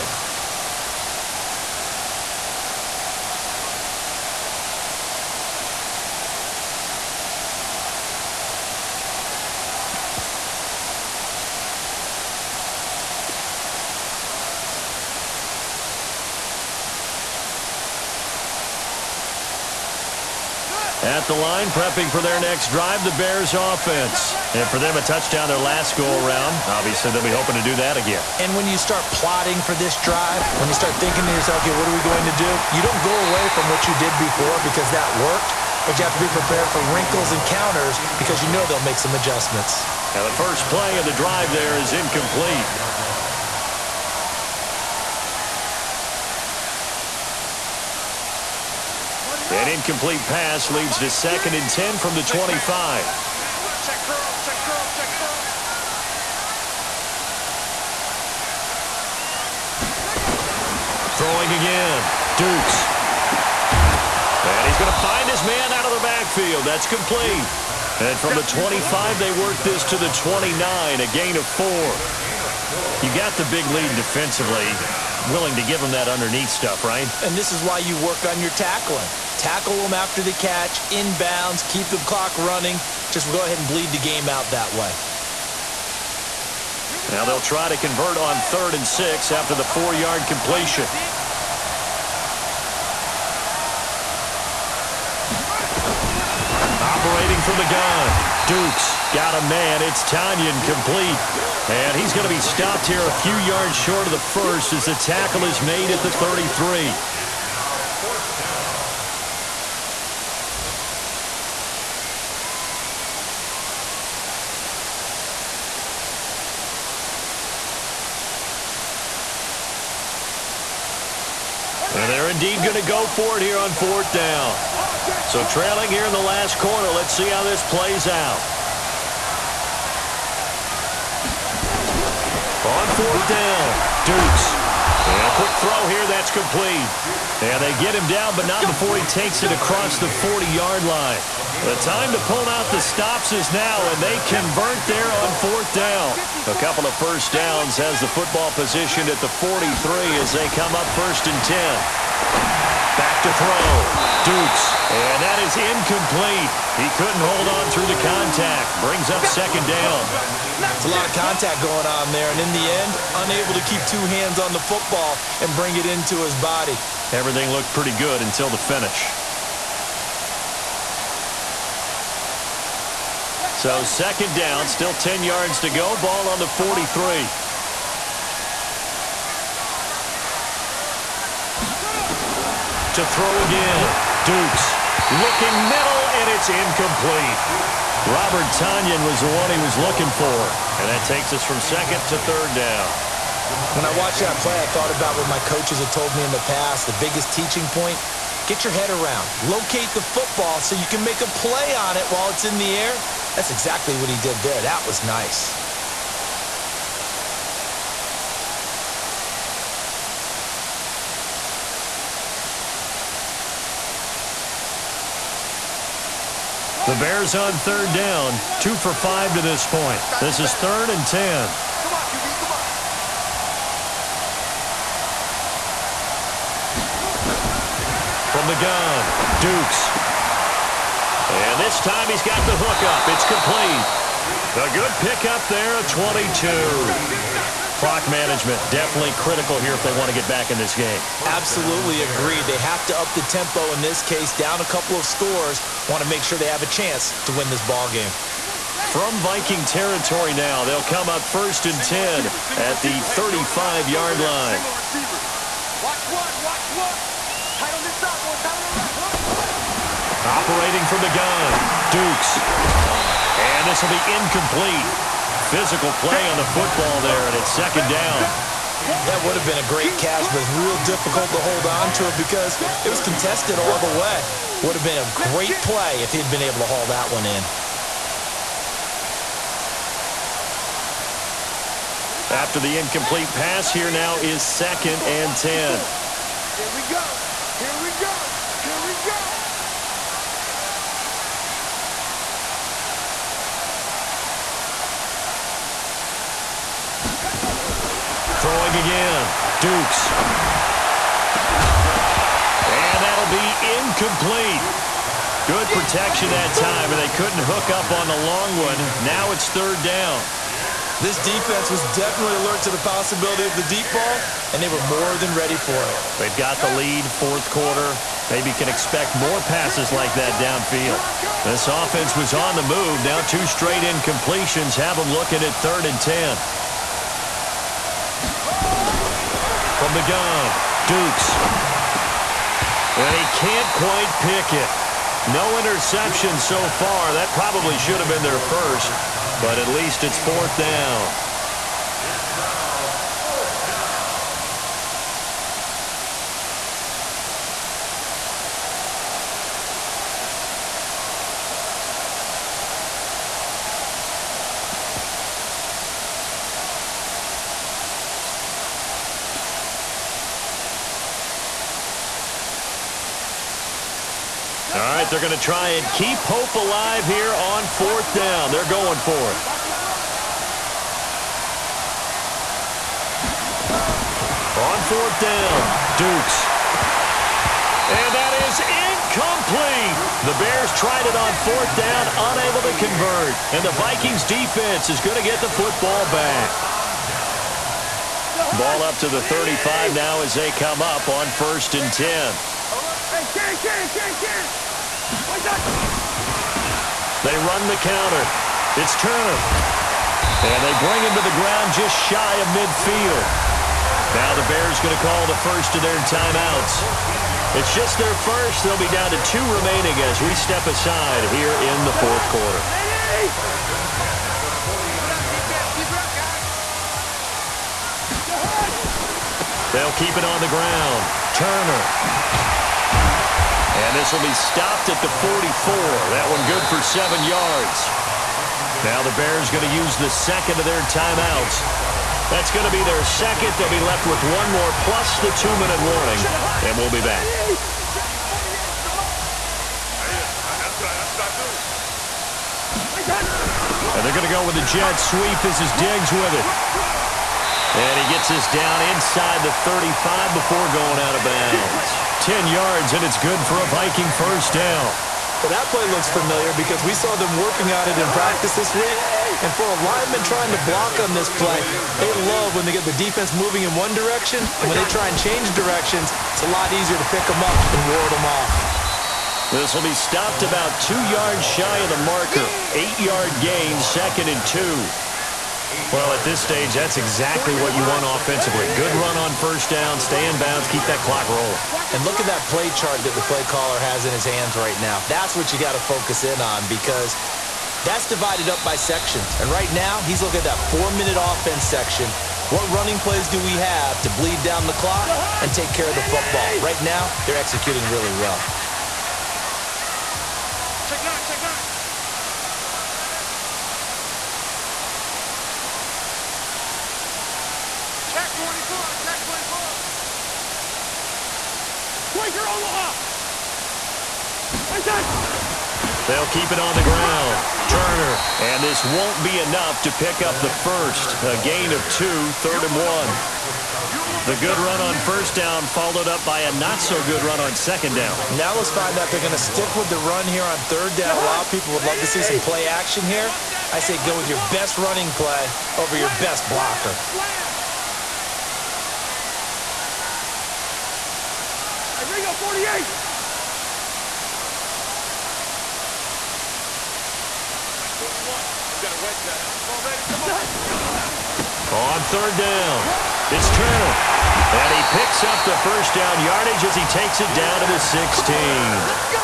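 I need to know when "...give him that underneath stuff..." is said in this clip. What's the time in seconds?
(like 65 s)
75 s.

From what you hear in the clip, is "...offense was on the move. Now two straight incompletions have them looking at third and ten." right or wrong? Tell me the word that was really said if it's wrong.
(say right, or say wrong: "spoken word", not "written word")
right.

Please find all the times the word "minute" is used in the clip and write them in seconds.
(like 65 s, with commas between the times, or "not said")
435 s, 490 s.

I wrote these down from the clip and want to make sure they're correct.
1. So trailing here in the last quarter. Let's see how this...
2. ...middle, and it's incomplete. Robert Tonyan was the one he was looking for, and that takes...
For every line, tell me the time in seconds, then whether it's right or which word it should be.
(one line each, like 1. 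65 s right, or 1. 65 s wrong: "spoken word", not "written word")
1. 125 s right
2. 185 s right.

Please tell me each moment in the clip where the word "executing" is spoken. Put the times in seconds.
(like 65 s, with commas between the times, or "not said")
497 s.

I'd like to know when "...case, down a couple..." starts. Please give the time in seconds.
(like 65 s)
244 s.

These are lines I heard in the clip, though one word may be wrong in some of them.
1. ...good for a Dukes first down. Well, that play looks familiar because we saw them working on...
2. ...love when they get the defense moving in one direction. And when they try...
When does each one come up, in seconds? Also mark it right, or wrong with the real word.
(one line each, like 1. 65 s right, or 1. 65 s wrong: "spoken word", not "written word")
1. 453 s wrong: "Viking", not "Dukes"
2. 462 s right.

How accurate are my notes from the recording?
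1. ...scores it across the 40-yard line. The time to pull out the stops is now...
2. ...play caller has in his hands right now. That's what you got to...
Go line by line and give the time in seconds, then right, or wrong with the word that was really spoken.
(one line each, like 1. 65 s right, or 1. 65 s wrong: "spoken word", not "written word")
1. 139 s wrong: "takes", not "scores"
2. 483 s right.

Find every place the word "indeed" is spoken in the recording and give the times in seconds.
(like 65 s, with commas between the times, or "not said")
122 s.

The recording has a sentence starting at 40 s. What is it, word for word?
Now, the first play of the drive there is incomplete.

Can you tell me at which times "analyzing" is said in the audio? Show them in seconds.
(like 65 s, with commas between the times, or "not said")
not said.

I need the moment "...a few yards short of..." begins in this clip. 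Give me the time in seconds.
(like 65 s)
103 s.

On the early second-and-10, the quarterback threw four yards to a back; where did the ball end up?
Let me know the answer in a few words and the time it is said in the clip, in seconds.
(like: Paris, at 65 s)
29, at 70 s.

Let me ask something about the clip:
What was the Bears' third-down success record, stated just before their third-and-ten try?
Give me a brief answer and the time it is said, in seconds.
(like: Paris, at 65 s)
2 for 5, at 218 s.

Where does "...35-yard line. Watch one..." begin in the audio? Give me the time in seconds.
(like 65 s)
253 s.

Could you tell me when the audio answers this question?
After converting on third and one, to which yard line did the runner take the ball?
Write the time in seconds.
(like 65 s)
557 s.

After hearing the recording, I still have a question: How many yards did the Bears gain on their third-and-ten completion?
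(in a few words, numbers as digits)
22.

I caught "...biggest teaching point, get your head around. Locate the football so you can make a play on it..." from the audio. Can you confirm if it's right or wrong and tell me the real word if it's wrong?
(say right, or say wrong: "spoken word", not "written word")
right.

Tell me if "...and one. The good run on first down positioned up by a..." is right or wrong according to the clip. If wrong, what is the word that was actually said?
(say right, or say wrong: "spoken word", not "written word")
wrong: "followed", not "positioned".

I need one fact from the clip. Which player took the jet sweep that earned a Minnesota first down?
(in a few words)
Diggs.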